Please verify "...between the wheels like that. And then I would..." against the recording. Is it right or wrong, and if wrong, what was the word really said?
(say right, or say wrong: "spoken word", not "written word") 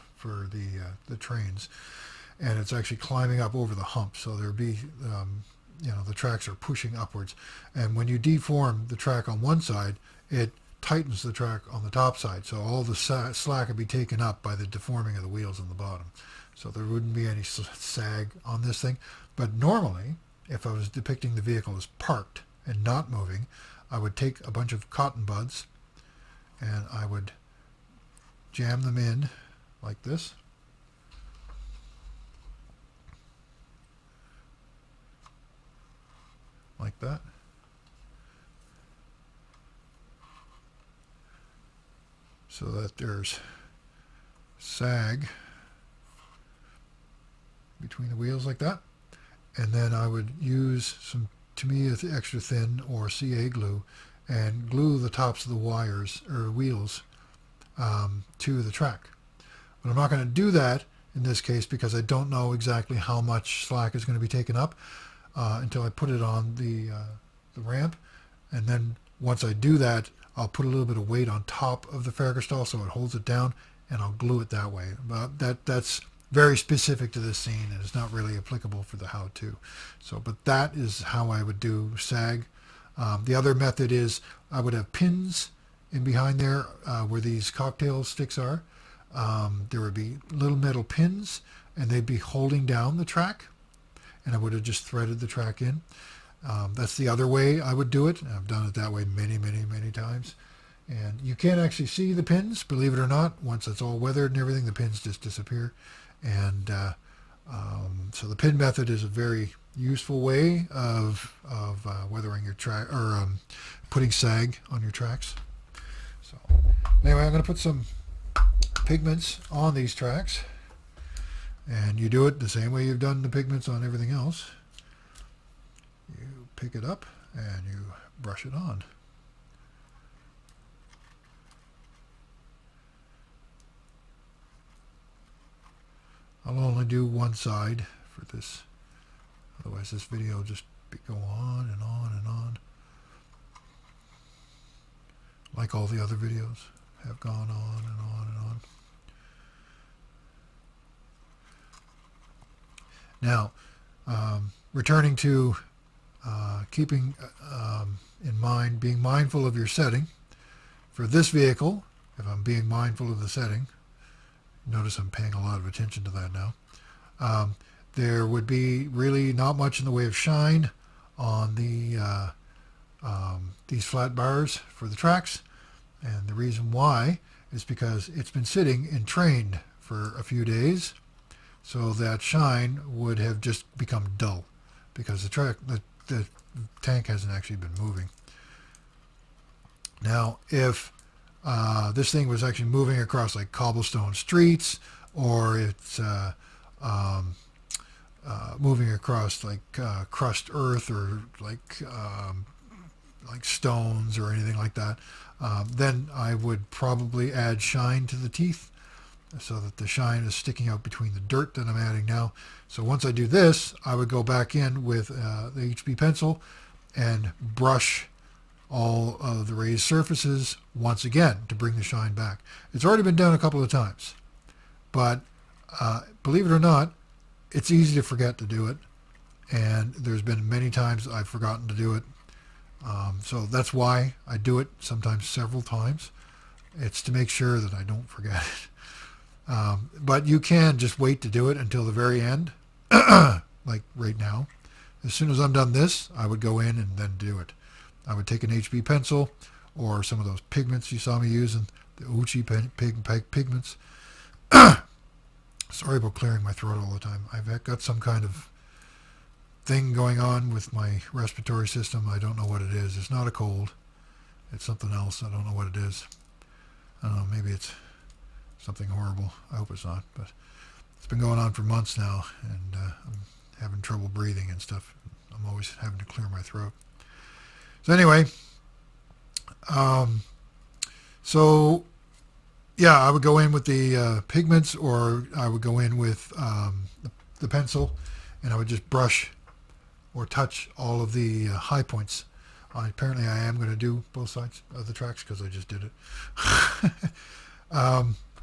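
right.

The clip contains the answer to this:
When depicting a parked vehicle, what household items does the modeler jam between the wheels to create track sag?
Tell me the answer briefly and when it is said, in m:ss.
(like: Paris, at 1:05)
cotton buds, at 0:24.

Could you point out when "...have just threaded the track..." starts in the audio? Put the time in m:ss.
1:34.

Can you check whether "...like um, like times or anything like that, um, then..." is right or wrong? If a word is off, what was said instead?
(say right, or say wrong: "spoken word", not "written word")
wrong: "stones", not "times".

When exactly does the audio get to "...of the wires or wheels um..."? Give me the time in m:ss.
0:55.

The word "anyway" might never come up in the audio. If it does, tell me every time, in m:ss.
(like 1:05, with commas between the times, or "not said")
1:57, 4:37.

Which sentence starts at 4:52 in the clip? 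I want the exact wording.
I, apparently, I am going to do both sides of the tracks because I just did it.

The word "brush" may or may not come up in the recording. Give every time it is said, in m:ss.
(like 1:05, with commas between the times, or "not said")
2:08, 3:37, 4:48.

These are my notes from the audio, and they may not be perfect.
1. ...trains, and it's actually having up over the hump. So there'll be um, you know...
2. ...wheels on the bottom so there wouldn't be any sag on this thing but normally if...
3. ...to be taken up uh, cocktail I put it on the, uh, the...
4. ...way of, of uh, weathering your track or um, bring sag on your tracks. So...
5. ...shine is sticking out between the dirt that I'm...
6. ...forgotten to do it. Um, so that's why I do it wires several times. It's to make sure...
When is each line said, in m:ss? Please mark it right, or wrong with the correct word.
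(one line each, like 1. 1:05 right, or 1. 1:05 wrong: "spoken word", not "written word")
1. 0:01 wrong: "climbing", not "having"
2. 0:15 right
3. 1:04 wrong: "until", not "cocktail"
4. 1:50 wrong: "putting", not "bring"
5. 3:29 right
6. 3:51 wrong: "sometimes", not "wires".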